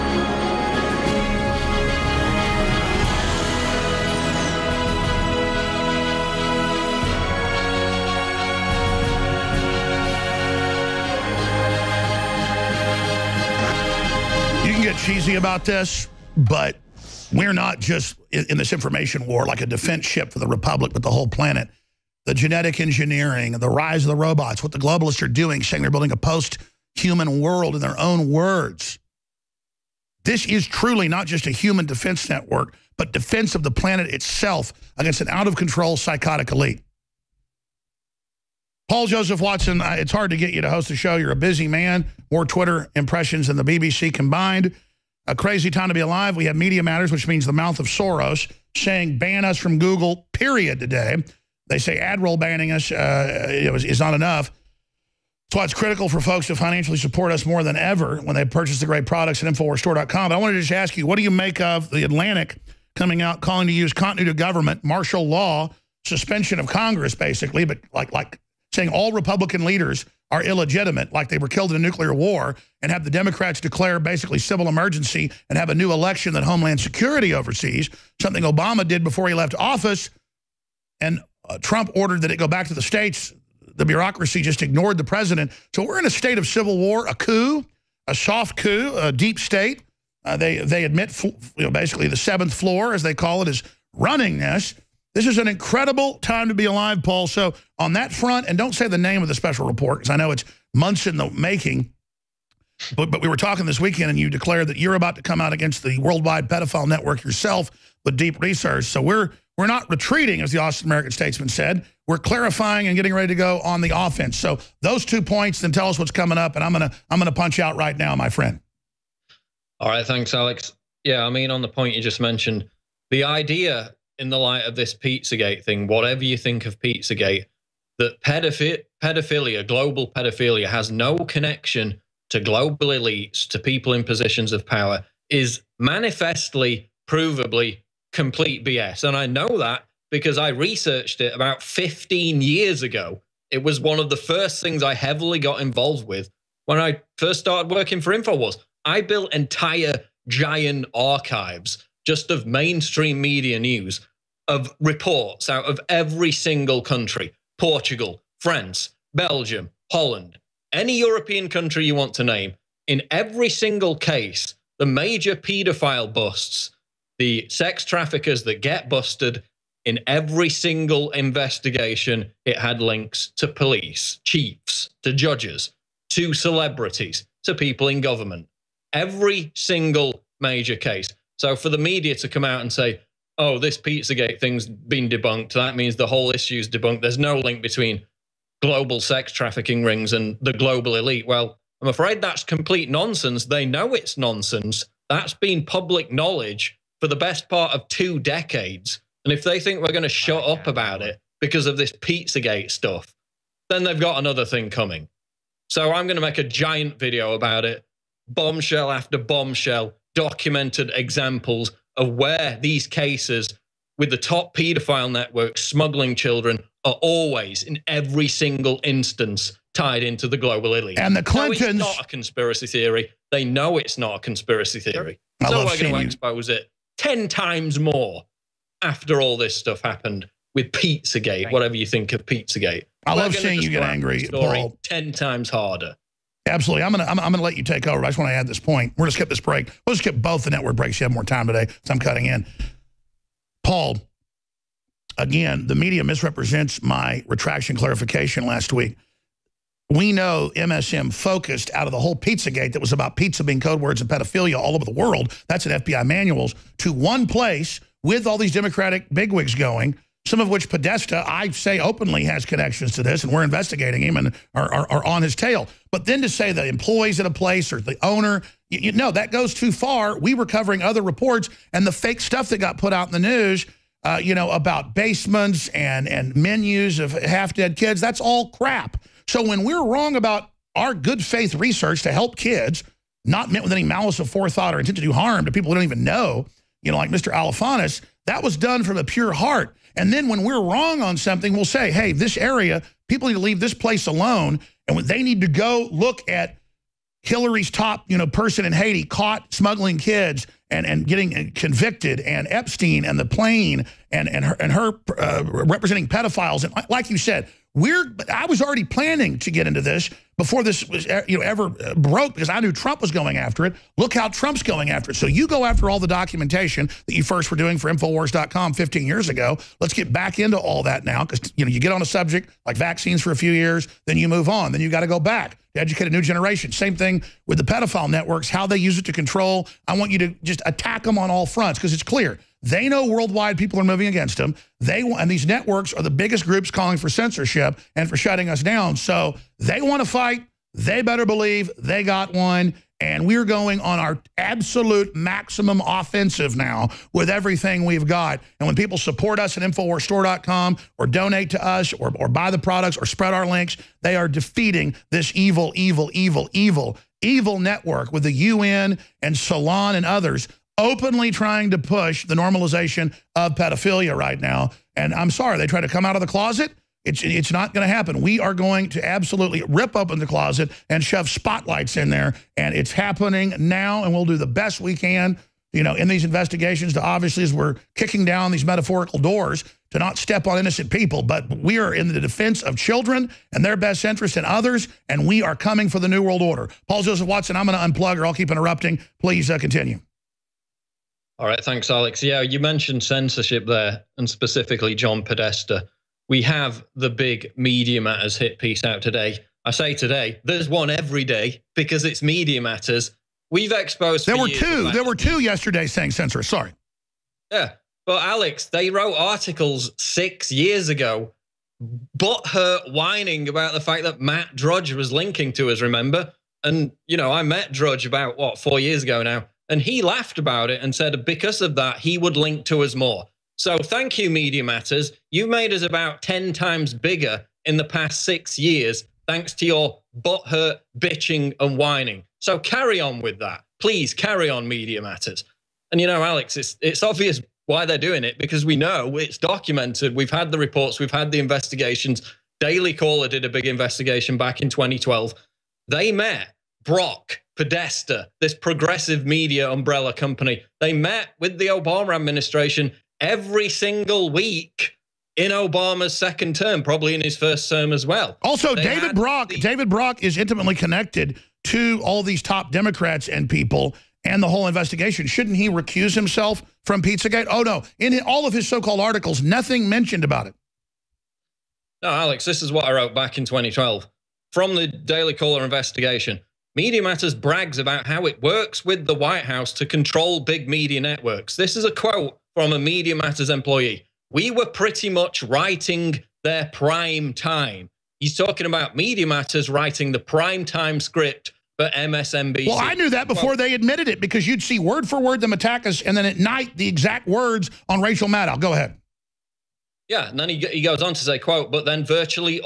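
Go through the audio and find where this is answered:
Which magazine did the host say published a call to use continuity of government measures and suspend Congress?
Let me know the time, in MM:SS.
01:01.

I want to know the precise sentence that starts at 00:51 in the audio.
They say AdRoll banning us uh, is not enough.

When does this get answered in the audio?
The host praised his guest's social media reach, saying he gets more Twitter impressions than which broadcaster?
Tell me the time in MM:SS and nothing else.
00:43.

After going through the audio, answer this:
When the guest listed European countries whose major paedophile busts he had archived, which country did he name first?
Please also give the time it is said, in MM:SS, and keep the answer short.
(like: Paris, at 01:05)
Portugal, at 02:37.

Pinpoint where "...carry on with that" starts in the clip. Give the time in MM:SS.
07:12.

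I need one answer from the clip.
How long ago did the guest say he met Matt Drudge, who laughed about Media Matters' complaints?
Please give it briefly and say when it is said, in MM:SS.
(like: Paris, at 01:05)
4 years ago, at 06:58.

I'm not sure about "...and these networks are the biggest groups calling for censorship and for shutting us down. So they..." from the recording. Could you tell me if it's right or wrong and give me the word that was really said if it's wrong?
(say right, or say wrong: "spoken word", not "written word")
right.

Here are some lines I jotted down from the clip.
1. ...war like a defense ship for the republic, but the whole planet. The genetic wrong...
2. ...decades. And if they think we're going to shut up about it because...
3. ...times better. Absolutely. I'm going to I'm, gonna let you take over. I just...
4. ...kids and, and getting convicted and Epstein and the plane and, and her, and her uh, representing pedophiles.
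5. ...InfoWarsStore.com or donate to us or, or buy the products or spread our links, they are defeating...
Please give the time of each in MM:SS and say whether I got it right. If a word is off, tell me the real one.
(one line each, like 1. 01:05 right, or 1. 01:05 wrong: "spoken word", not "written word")
1. 00:19 wrong: "engineering", not "wrong"
2. 03:18 right
3. 03:55 wrong: "harder", not "better"
4. 04:59 right
5. 05:49 right.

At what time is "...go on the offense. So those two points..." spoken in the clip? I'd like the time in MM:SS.
01:53.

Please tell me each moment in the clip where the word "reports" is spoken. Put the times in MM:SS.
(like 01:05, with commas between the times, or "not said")
01:39, 02:34, 04:31, 07:20.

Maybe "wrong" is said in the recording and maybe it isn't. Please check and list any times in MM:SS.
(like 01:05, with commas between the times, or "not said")
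04:39, 04:50.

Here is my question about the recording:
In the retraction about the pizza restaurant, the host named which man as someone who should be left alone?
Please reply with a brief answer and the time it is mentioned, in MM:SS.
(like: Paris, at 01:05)
Mr. Alefantis, at 04:47.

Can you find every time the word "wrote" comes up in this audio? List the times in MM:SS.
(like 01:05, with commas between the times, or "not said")
06:48, 07:52.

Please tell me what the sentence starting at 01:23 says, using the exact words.
The bureaucracy just ignored the president.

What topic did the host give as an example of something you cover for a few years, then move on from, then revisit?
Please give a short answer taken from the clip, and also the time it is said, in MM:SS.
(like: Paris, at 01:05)
Vaccines, at 05:22.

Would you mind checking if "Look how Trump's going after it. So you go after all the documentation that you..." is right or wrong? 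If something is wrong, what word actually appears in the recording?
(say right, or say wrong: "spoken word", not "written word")
right.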